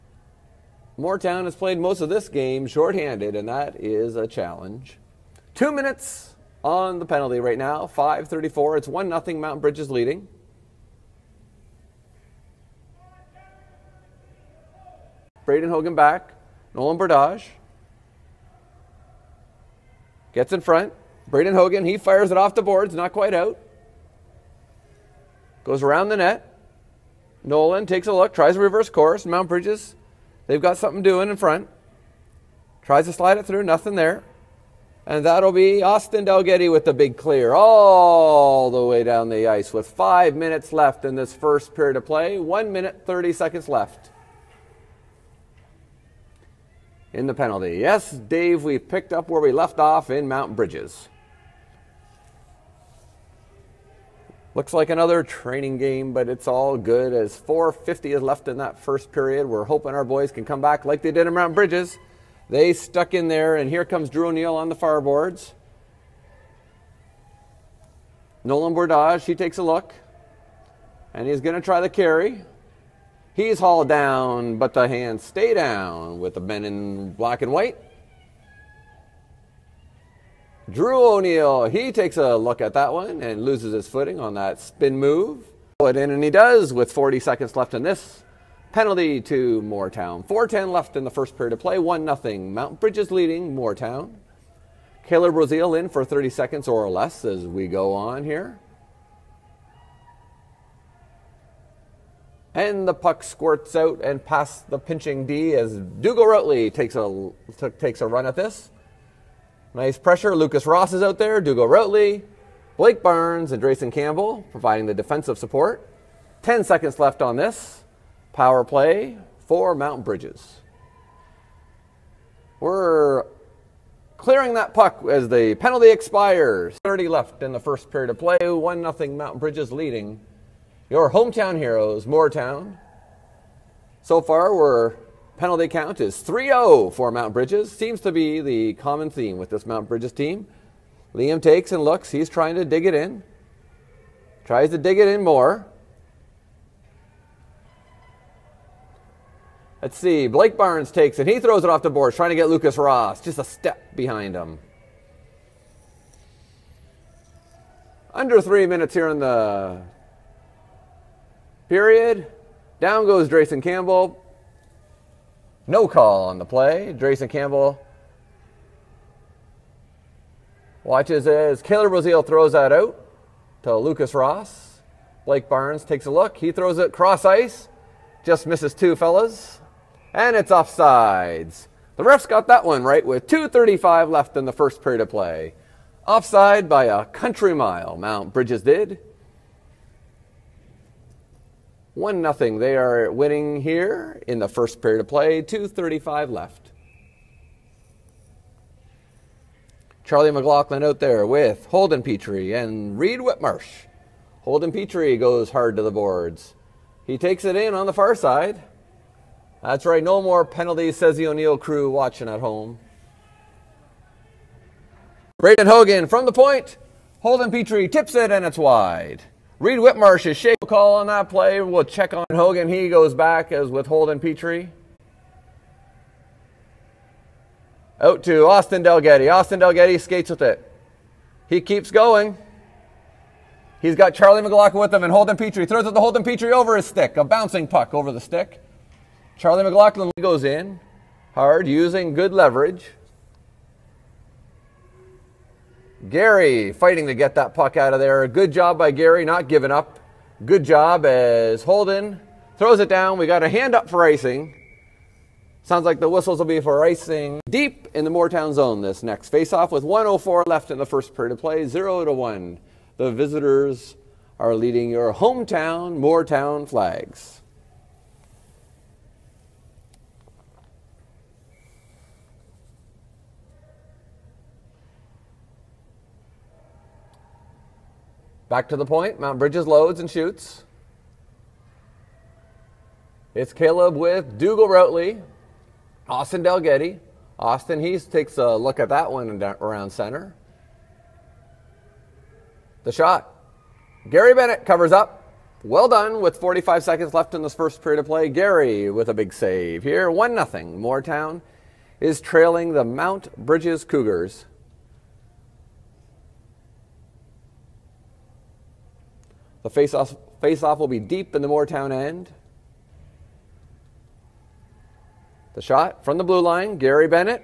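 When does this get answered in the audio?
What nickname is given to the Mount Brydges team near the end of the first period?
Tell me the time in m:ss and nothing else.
5:03.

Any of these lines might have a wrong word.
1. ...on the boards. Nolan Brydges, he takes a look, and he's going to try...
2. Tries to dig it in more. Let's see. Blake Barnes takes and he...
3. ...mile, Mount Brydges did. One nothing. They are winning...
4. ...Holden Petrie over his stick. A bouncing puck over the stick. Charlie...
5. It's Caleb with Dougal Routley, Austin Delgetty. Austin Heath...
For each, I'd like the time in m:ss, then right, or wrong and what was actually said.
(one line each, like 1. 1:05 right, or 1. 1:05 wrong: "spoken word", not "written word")
1. 1:04 wrong: "Bordage", not "Brydges"
2. 2:24 right
3. 3:07 right
4. 3:55 right
5. 4:43 right.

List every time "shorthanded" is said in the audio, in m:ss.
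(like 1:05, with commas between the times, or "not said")
0:02.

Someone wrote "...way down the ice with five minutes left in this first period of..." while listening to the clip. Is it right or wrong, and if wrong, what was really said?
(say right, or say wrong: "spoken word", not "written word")
right.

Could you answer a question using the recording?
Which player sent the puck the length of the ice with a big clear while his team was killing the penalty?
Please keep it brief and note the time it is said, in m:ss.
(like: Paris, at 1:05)
Austin Dalgetty, at 0:35.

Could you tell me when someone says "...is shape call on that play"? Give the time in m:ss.
3:40.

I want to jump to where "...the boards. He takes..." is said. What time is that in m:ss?
3:25.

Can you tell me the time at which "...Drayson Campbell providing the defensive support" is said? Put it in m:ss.
1:53.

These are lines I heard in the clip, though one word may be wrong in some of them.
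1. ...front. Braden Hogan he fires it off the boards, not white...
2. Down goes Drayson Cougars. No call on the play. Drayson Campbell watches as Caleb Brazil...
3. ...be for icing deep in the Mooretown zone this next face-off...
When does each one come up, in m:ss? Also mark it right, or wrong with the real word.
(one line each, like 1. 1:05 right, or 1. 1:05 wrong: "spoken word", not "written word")
1. 0:20 wrong: "quite", not "white"
2. 2:42 wrong: "Campbell", not "Cougars"
3. 4:16 right.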